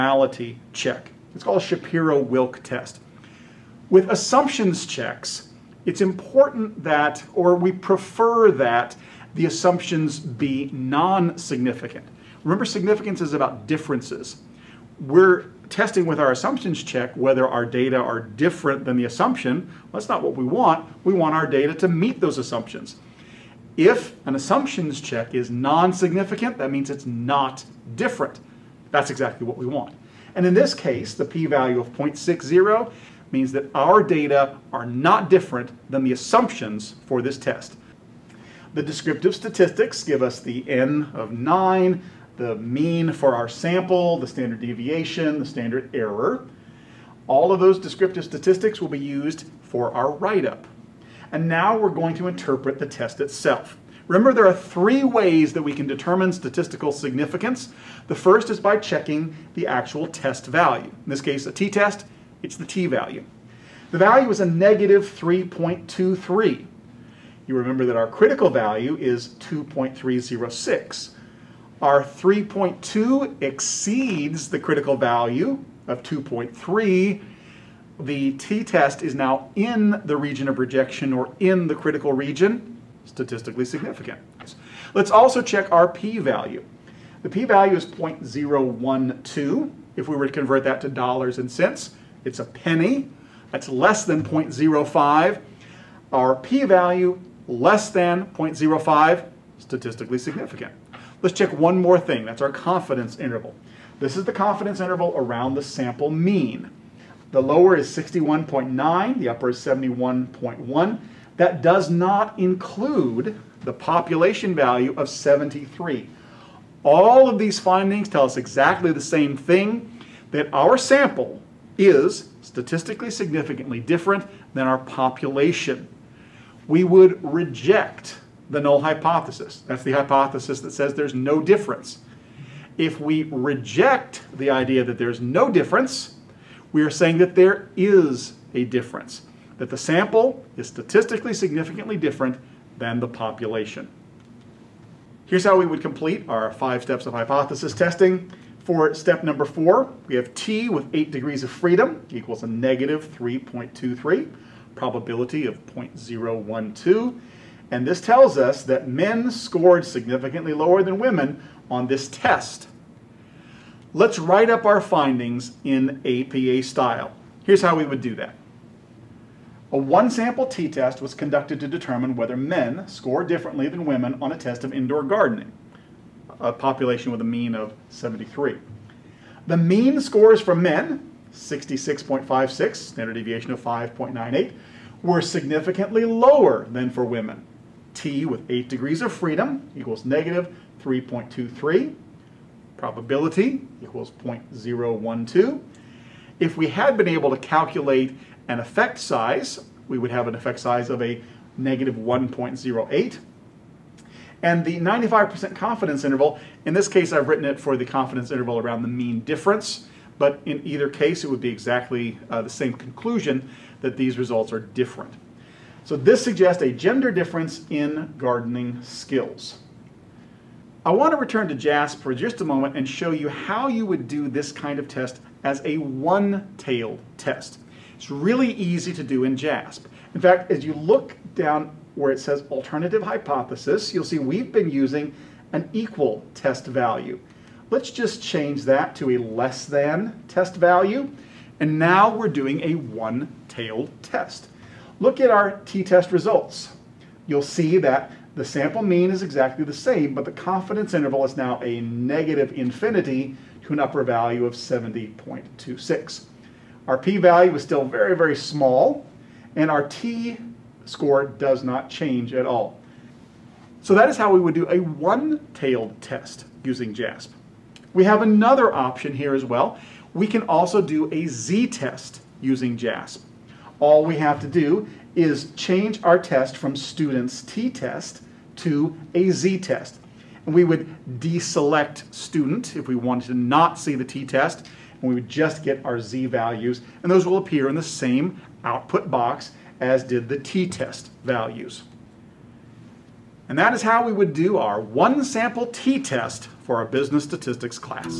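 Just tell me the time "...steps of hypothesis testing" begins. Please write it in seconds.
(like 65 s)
146 s.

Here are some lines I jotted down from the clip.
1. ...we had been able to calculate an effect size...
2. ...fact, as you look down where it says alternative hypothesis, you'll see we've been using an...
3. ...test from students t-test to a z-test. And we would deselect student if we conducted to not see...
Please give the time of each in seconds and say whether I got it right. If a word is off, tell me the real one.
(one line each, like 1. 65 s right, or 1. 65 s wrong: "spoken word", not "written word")
1. 196 s right
2. 230 s right
3. 276 s wrong: "wanted", not "conducted".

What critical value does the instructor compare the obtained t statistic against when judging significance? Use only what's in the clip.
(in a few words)
2.306.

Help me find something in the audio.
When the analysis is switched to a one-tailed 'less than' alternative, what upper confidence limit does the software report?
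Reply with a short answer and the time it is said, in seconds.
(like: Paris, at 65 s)
70.26, at 254 s.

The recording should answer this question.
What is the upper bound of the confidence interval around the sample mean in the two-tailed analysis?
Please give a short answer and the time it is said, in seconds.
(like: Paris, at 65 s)
71.1, at 109 s.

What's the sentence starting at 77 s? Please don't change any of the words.
The t-test is now in the region of rejection or in the critical region, statistically significant.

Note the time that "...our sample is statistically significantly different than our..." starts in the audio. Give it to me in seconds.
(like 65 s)
120 s.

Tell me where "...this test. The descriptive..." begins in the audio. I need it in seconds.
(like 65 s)
37 s.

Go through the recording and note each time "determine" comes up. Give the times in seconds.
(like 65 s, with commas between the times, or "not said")
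55 s, 171 s.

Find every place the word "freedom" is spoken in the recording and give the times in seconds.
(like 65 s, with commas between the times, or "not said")
151 s, 189 s.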